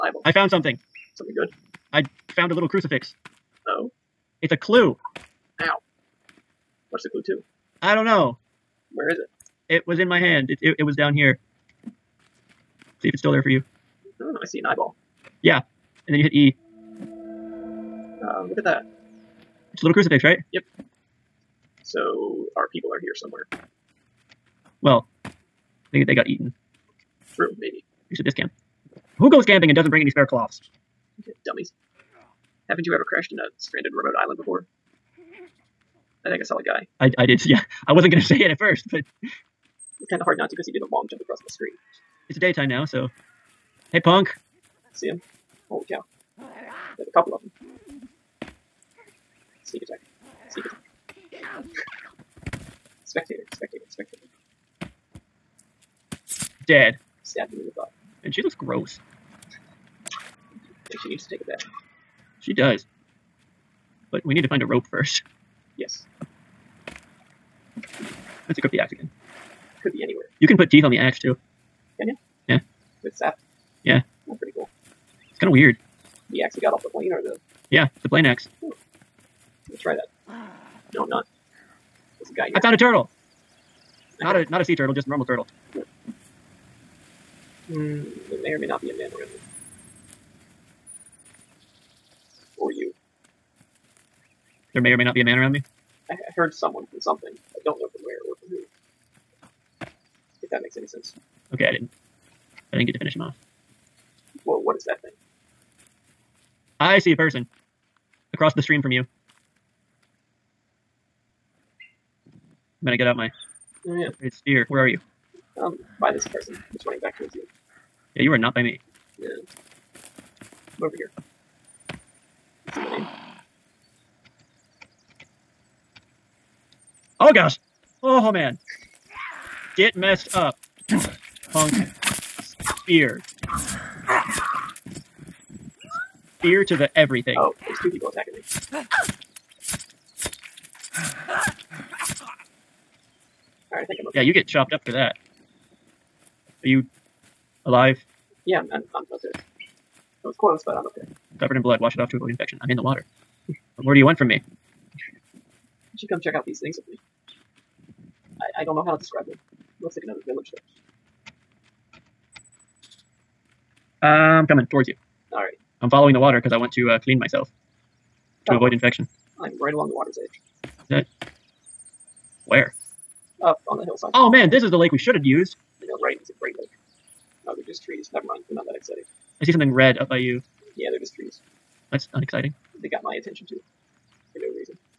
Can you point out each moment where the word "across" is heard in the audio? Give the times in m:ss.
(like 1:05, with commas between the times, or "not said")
0:41, 1:48.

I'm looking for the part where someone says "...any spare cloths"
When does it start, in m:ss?
0:30.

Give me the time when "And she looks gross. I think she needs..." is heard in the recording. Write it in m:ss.
0:58.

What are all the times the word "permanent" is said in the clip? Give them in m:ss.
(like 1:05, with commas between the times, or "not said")
not said.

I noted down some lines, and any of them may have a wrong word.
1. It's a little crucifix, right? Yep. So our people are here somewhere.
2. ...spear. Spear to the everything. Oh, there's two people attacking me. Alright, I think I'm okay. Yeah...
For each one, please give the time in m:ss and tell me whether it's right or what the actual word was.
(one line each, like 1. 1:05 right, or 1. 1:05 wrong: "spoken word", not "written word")
1. 0:19 right
2. 2:12 right.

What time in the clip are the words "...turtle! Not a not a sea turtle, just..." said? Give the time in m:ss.
1:22.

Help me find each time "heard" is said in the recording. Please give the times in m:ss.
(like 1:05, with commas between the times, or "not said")
1:36.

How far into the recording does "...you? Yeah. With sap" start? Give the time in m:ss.
1:12.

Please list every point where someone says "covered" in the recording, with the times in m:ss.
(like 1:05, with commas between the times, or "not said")
2:31.